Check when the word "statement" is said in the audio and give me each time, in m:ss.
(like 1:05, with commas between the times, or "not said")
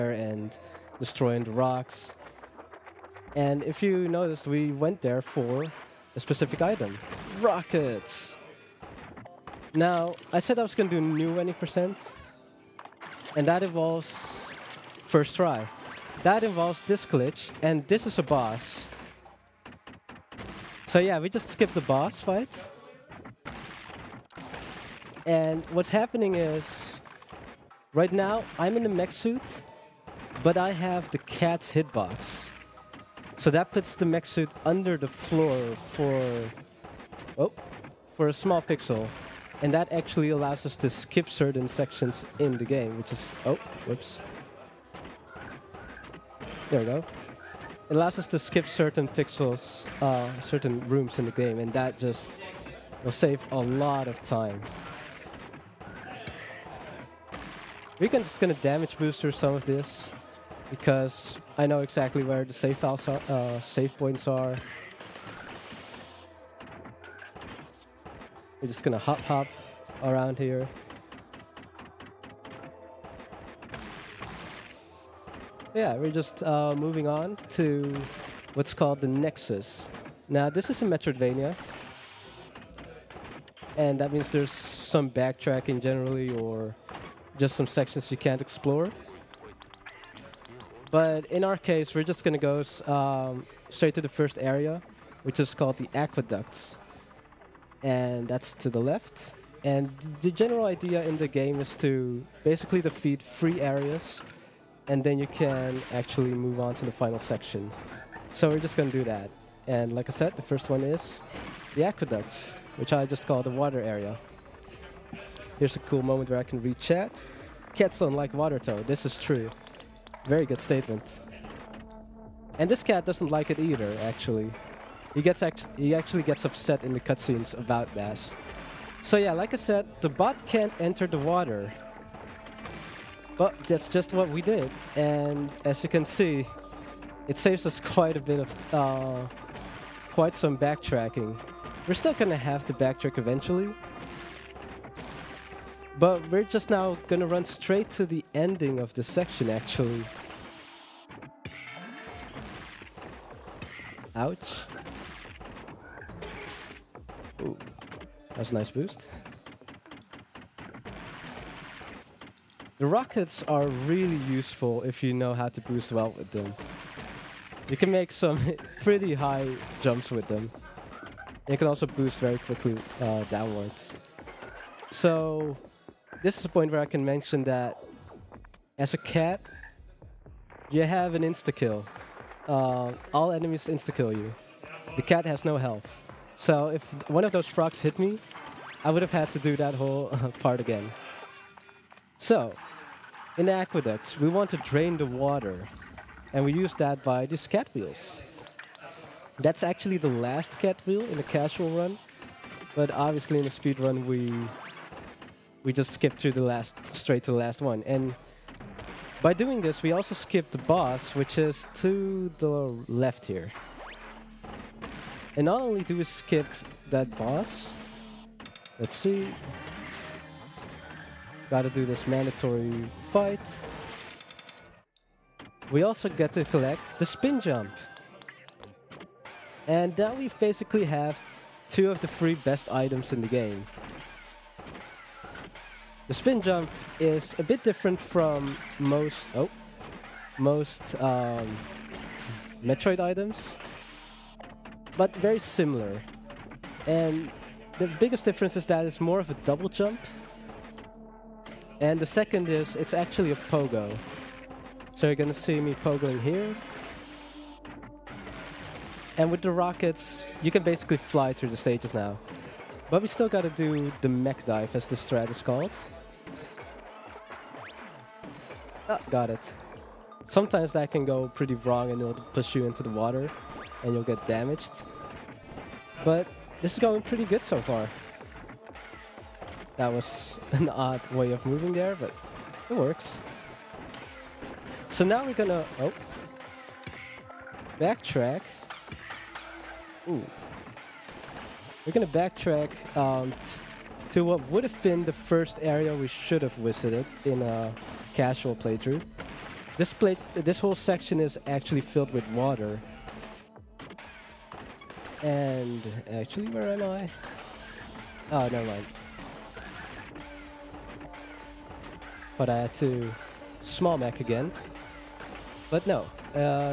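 2:00.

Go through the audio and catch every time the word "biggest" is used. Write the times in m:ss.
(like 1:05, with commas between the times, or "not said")
4:07.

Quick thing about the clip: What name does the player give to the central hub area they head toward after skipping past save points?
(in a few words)
The Nexus.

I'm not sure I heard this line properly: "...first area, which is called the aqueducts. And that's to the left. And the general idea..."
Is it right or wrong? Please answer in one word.
right.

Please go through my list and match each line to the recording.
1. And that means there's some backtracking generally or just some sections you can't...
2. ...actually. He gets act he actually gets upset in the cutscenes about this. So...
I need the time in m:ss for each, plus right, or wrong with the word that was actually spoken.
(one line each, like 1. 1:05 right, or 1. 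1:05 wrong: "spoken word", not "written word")
1. 1:23 right
2. 2:04 right.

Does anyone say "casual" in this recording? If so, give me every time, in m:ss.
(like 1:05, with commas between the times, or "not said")
3:21, 4:58.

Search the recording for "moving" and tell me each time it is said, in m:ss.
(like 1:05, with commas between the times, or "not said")
1:16, 4:41.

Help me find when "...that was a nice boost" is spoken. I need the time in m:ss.
2:38.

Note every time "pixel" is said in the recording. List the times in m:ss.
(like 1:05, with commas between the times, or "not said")
0:38, 0:49.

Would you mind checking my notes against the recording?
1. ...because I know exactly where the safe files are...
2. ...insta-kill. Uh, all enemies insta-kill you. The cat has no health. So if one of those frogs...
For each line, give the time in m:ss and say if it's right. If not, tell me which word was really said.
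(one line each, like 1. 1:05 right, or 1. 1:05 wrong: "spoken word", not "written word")
1. 1:00 right
2. 3:01 right.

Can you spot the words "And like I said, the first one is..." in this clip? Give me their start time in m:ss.
1:49.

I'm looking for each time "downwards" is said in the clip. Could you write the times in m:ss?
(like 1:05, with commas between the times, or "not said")
2:53.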